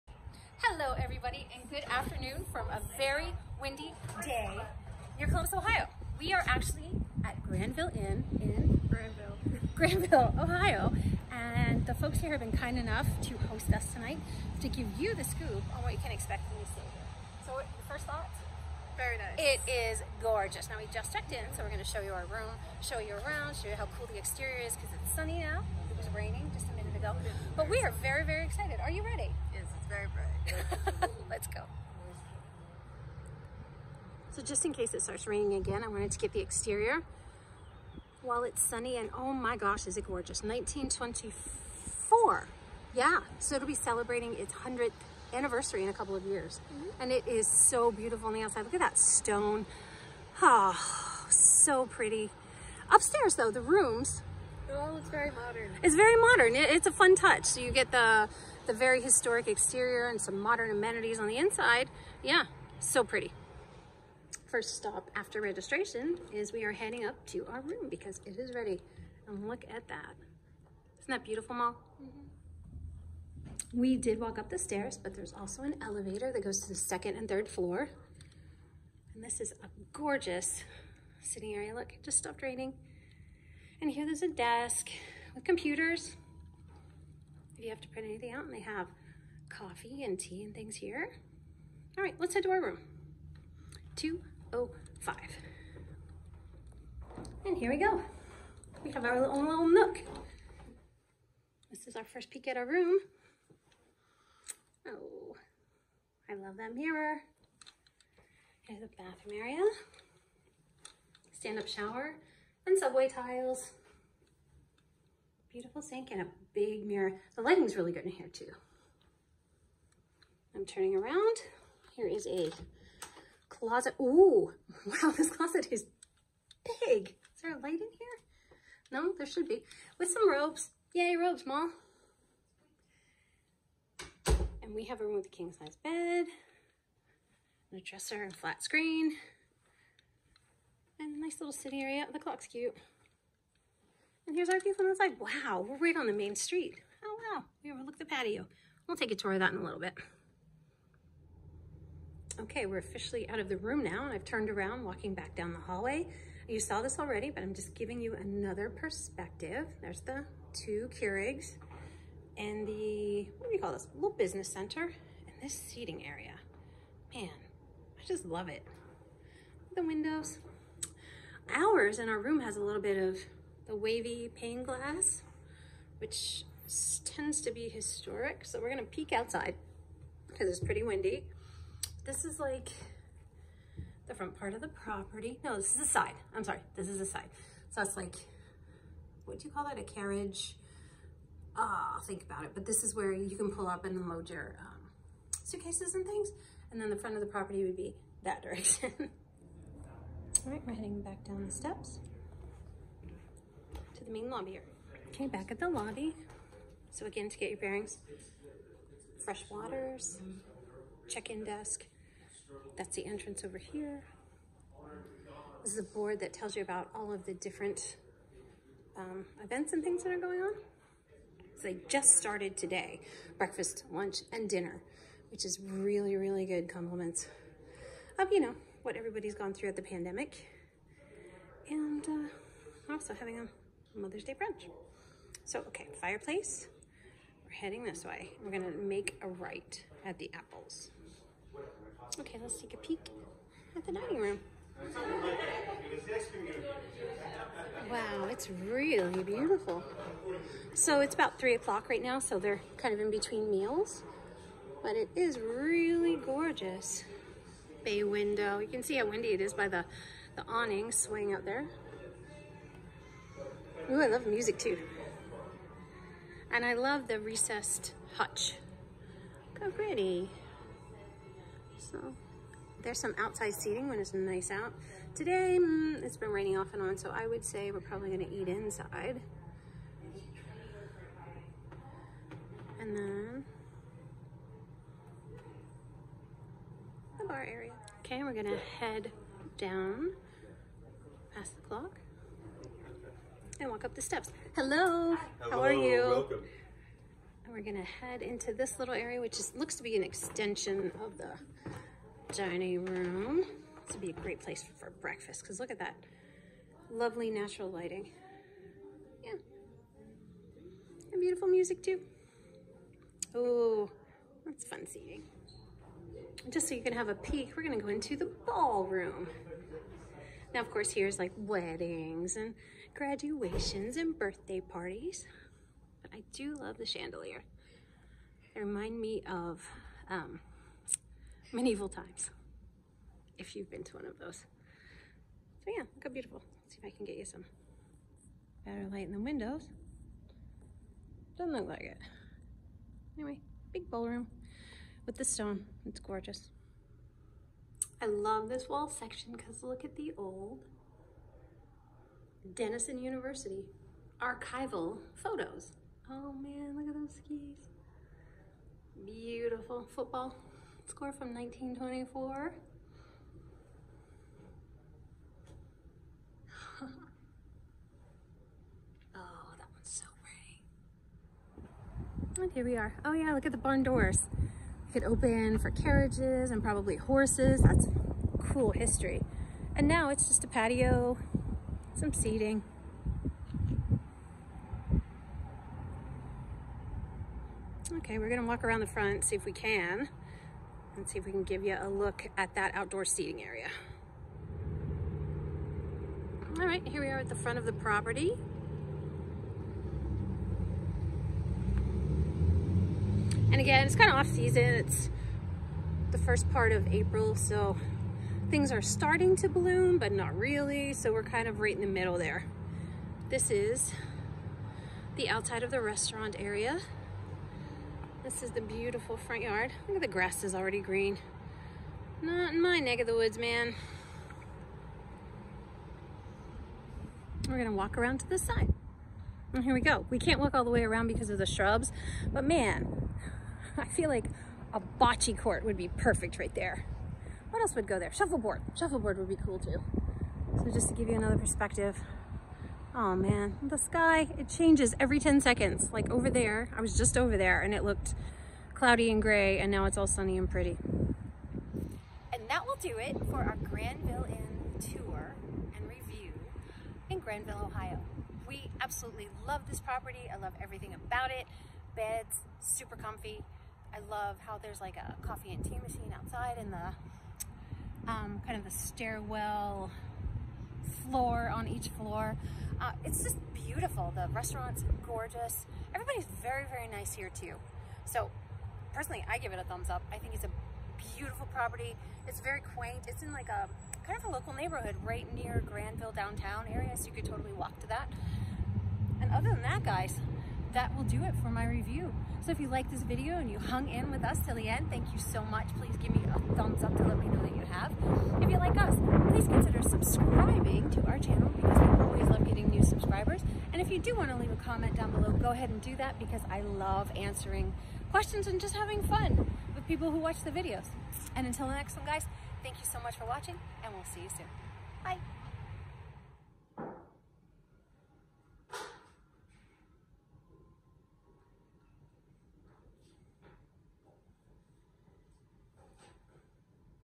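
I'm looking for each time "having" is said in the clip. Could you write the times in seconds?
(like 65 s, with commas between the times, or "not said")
233 s, 508 s.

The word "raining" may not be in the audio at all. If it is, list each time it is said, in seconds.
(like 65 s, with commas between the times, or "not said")
26 s, 35 s, 82 s, 276 s.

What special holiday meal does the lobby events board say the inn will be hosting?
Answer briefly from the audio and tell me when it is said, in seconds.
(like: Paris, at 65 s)
Mother's Day brunch, at 233 s.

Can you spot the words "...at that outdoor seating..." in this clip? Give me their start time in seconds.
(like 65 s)
392 s.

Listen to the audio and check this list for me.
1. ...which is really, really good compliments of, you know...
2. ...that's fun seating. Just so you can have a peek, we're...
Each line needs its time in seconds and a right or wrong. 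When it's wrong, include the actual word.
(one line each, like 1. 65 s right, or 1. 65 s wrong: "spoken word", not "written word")
1. 225 s right
2. 314 s right.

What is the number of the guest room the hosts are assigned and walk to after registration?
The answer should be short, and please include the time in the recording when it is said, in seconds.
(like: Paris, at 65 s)
205, at 93 s.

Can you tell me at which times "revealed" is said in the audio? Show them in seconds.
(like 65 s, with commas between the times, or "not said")
not said.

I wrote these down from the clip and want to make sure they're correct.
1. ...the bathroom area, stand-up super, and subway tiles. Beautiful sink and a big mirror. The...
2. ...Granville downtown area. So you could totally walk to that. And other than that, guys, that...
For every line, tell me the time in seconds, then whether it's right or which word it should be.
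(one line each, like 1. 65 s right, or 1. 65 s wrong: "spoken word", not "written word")
1. 108 s wrong: "shower", not "super"
2. 485 s right.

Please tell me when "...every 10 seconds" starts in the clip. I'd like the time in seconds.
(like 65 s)
445 s.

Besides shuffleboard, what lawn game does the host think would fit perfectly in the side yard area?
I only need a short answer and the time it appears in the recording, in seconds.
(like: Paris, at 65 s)
Bocce, at 434 s.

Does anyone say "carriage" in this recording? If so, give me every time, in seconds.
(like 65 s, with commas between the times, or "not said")
189 s, 375 s.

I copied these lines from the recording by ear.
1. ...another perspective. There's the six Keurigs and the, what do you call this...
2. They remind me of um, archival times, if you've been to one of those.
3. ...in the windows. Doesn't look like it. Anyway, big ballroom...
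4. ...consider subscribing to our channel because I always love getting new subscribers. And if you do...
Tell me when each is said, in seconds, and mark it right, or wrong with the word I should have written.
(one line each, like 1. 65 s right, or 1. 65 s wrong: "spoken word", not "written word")
1. 158 s wrong: "two", not "six"
2. 328 s wrong: "medieval", not "archival"
3. 339 s right
4. 499 s right.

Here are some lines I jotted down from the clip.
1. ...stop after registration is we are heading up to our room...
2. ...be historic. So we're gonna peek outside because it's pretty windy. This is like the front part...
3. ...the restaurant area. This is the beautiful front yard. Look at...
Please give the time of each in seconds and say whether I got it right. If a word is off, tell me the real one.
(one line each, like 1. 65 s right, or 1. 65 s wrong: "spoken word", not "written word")
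1. 64 s right
2. 177 s right
3. 415 s right.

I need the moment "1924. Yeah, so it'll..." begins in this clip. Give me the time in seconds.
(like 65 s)
40 s.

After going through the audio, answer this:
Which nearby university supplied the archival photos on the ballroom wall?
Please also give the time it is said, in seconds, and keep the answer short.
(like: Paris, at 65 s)
Denison University, at 352 s.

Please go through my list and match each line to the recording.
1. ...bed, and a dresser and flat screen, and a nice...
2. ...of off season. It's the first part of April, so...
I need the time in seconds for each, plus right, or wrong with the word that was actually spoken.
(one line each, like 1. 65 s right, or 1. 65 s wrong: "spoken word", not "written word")
1. 135 s right
2. 404 s right.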